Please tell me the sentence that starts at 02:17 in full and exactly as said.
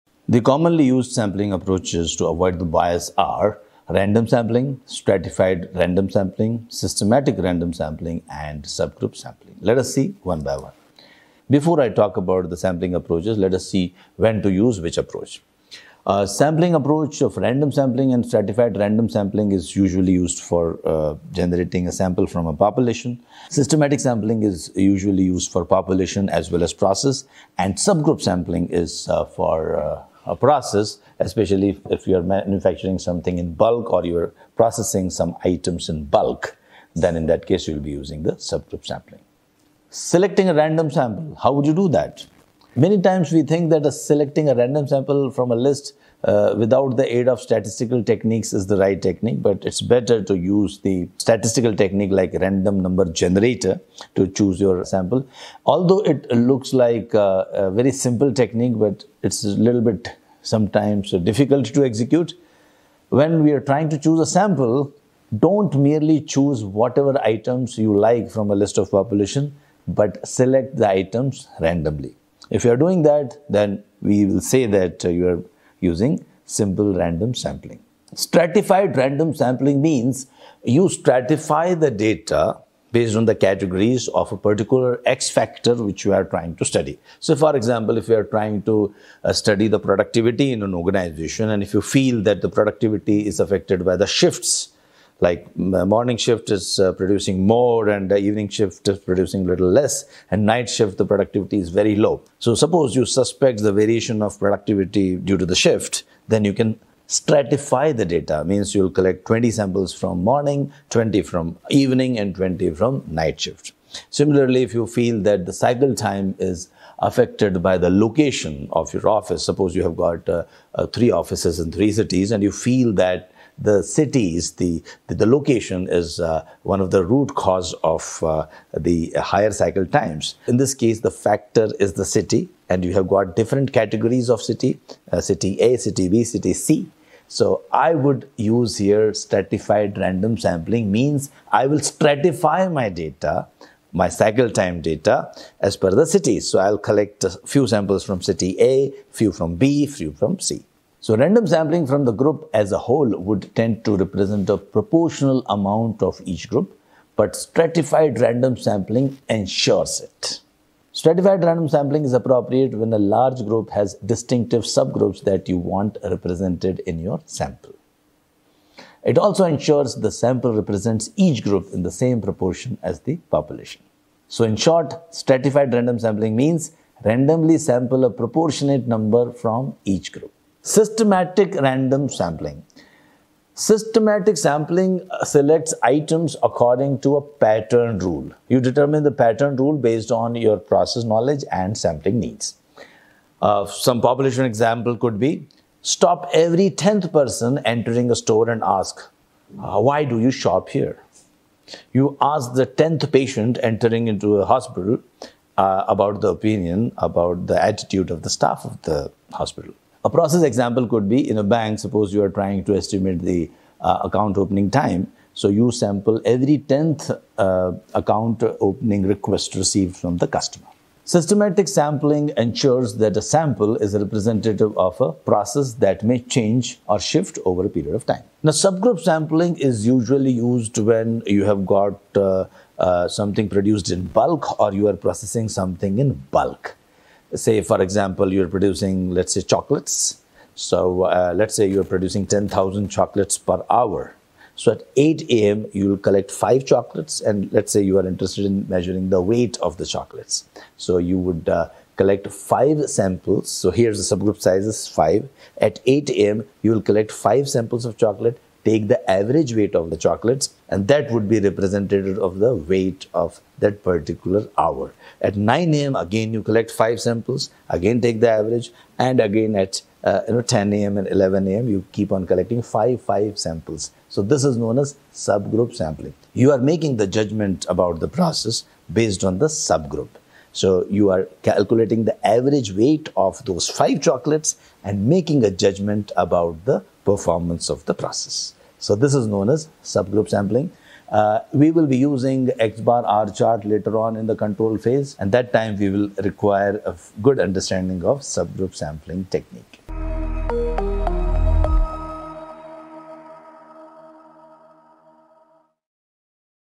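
So I would use here stratified random sampling means I will stratify my data my cycle time data as per the cities.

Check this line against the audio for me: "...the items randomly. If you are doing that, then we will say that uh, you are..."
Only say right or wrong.
right.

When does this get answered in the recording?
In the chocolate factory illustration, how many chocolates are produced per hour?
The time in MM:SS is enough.
04:02.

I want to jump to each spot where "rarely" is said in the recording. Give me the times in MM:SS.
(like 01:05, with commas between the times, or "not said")
not said.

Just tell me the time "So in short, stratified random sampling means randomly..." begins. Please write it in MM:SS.
02:54.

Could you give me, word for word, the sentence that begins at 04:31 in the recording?
you keep on collecting five five samples.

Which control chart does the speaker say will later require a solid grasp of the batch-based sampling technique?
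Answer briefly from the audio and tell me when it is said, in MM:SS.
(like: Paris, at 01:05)
X bar R chart, at 04:52.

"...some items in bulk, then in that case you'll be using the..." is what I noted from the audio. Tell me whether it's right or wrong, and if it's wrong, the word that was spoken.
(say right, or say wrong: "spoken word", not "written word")
right.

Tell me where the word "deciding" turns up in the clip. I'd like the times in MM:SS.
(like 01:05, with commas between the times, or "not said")
not said.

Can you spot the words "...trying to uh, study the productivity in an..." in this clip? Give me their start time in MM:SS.
01:28.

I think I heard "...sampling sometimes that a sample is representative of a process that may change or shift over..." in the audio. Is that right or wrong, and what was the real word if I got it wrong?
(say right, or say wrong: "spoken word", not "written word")
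wrong: "ensures", not "sometimes".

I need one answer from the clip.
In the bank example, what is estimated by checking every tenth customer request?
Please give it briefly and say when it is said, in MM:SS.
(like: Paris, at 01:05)
account opening time, at 03:34.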